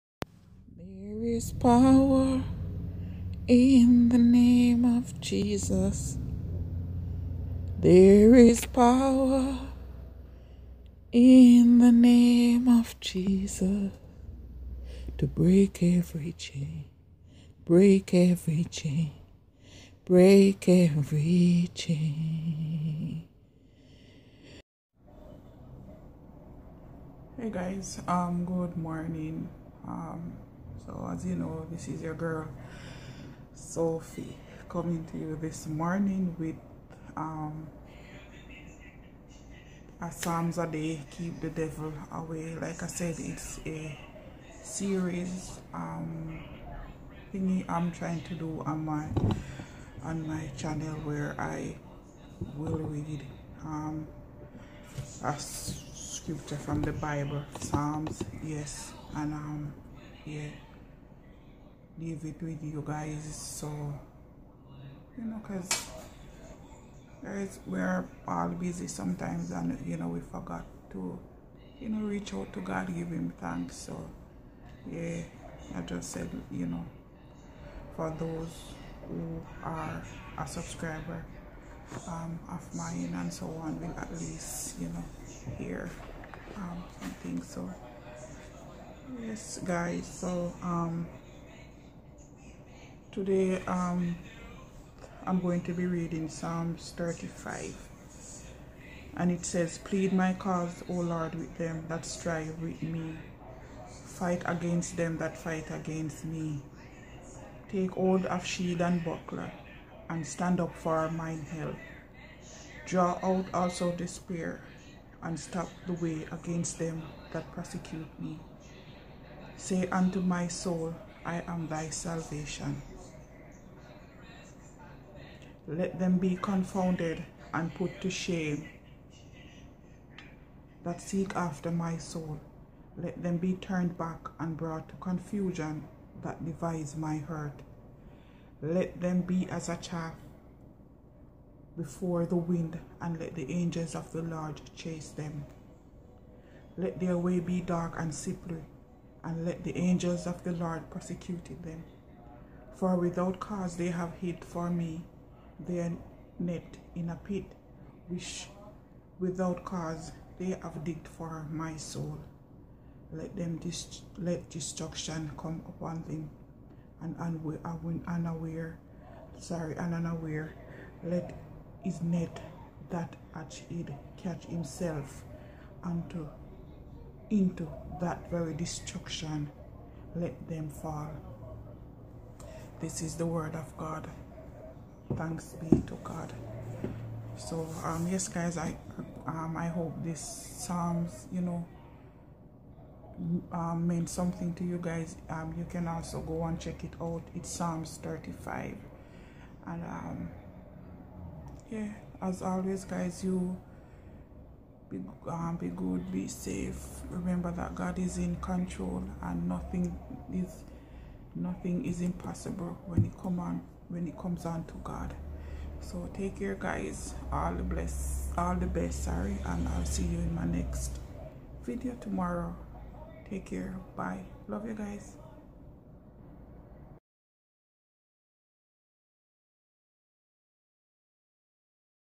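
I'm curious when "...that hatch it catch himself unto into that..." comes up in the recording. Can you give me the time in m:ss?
2:52.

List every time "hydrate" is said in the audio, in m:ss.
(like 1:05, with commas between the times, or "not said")
not said.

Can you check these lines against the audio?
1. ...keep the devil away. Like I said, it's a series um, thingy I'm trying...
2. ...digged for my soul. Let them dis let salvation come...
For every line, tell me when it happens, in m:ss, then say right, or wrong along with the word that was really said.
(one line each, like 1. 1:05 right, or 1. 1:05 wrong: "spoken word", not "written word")
1. 0:41 right
2. 2:40 wrong: "destruction", not "salvation".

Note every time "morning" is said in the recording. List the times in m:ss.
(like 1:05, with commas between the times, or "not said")
0:28, 0:35.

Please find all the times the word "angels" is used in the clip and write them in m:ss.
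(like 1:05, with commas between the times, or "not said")
2:23, 2:29.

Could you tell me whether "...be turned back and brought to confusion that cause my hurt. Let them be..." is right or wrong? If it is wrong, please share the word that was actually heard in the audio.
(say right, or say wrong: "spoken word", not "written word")
wrong: "devise", not "cause".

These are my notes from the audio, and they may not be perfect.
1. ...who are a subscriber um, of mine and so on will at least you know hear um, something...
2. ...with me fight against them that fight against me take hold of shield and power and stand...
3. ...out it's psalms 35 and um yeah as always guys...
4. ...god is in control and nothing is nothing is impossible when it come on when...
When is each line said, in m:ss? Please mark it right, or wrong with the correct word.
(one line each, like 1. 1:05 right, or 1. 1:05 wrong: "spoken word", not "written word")
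1. 1:19 right
2. 1:42 wrong: "buckler", not "power"
3. 3:17 right
4. 3:27 right.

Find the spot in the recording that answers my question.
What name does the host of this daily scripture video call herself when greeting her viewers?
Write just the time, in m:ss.
0:33.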